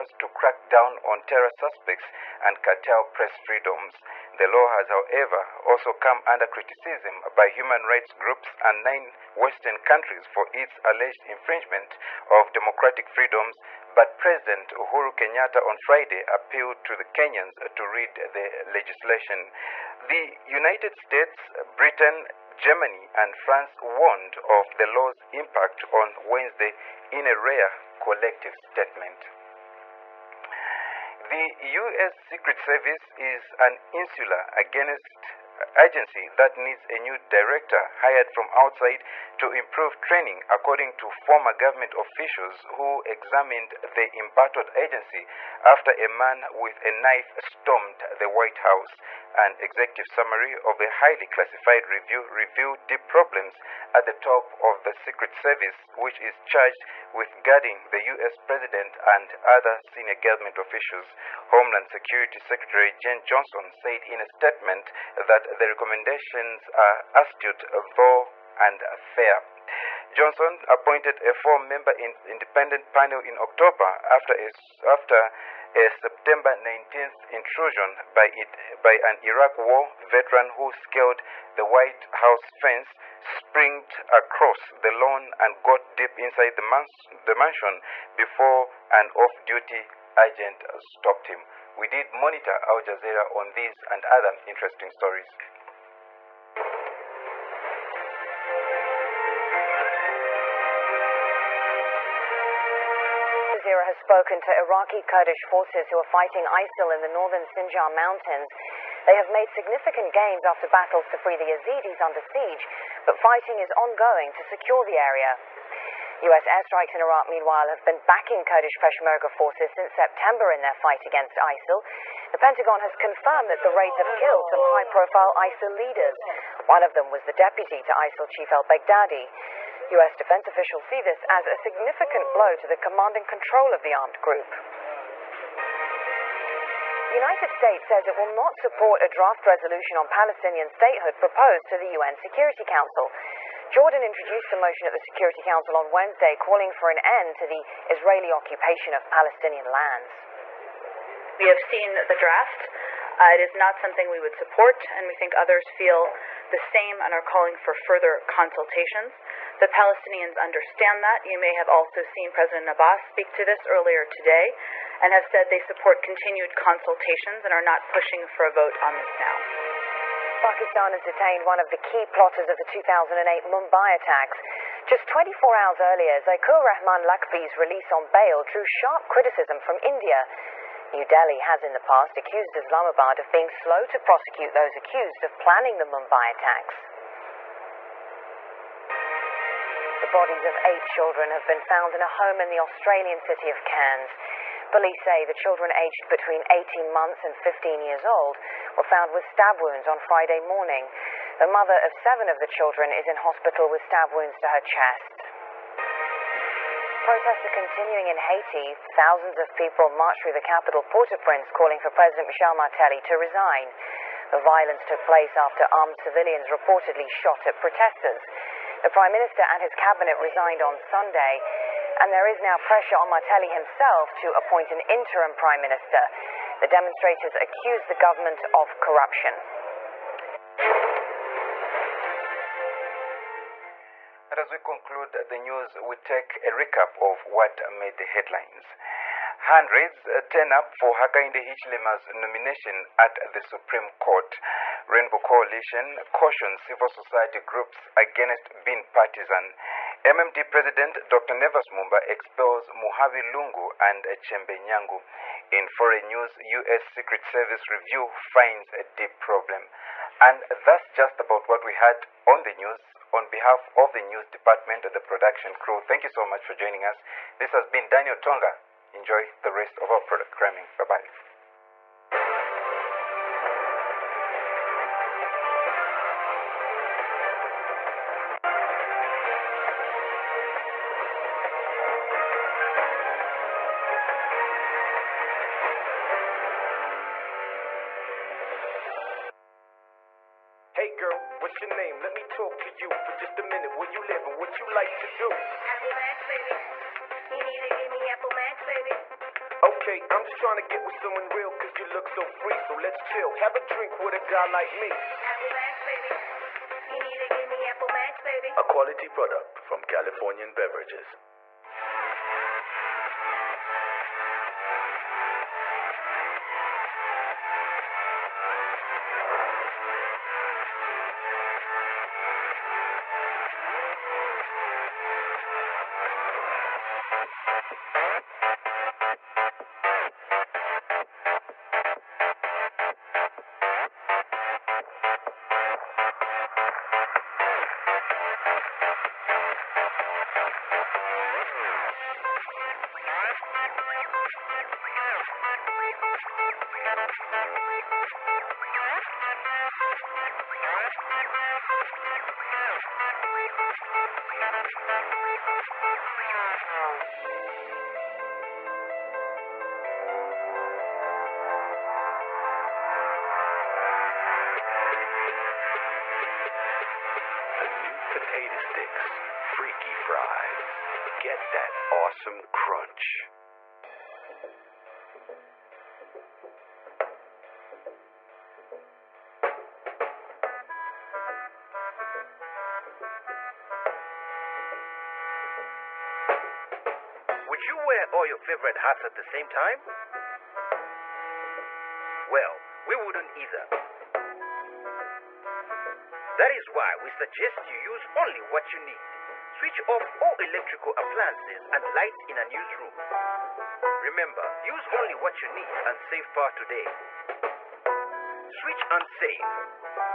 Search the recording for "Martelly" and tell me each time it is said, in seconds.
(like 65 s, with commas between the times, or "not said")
212 s, 223 s.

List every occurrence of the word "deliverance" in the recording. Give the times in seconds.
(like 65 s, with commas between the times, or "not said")
not said.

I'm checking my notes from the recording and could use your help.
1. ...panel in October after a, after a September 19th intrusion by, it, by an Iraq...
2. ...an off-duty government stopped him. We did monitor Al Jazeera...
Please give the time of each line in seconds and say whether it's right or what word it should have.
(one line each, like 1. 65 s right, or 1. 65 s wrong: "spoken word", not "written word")
1. 72 s right
2. 88 s wrong: "agent", not "government".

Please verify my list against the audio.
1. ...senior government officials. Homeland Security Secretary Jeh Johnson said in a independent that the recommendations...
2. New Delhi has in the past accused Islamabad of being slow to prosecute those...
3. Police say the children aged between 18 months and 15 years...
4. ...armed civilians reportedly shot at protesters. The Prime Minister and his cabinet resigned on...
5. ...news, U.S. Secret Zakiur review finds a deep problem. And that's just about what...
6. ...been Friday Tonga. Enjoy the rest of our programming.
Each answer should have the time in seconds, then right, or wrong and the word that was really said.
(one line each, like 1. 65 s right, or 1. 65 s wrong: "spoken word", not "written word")
1. 59 s wrong: "statement", not "independent"
2. 180 s right
3. 194 s right
4. 215 s right
5. 256 s wrong: "Service", not "Zakiur"
6. 267 s wrong: "Daniel", not "Friday".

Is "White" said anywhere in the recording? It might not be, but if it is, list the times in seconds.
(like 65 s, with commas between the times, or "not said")
48 s, 81 s.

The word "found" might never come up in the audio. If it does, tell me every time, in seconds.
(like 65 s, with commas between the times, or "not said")
191 s, 198 s.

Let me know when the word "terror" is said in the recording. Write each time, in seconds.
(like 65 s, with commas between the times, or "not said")
1 s.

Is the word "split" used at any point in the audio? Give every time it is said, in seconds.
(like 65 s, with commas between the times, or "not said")
not said.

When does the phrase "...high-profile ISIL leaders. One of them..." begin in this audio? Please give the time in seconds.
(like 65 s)
124 s.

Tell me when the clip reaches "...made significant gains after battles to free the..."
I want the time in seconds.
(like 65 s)
109 s.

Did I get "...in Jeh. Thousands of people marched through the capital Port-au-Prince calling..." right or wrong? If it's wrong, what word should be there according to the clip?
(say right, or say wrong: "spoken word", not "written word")
wrong: "Haiti", not "Jeh".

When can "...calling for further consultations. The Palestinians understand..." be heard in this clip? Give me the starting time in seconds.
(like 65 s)
157 s.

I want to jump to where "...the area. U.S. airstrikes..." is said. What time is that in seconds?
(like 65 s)
114 s.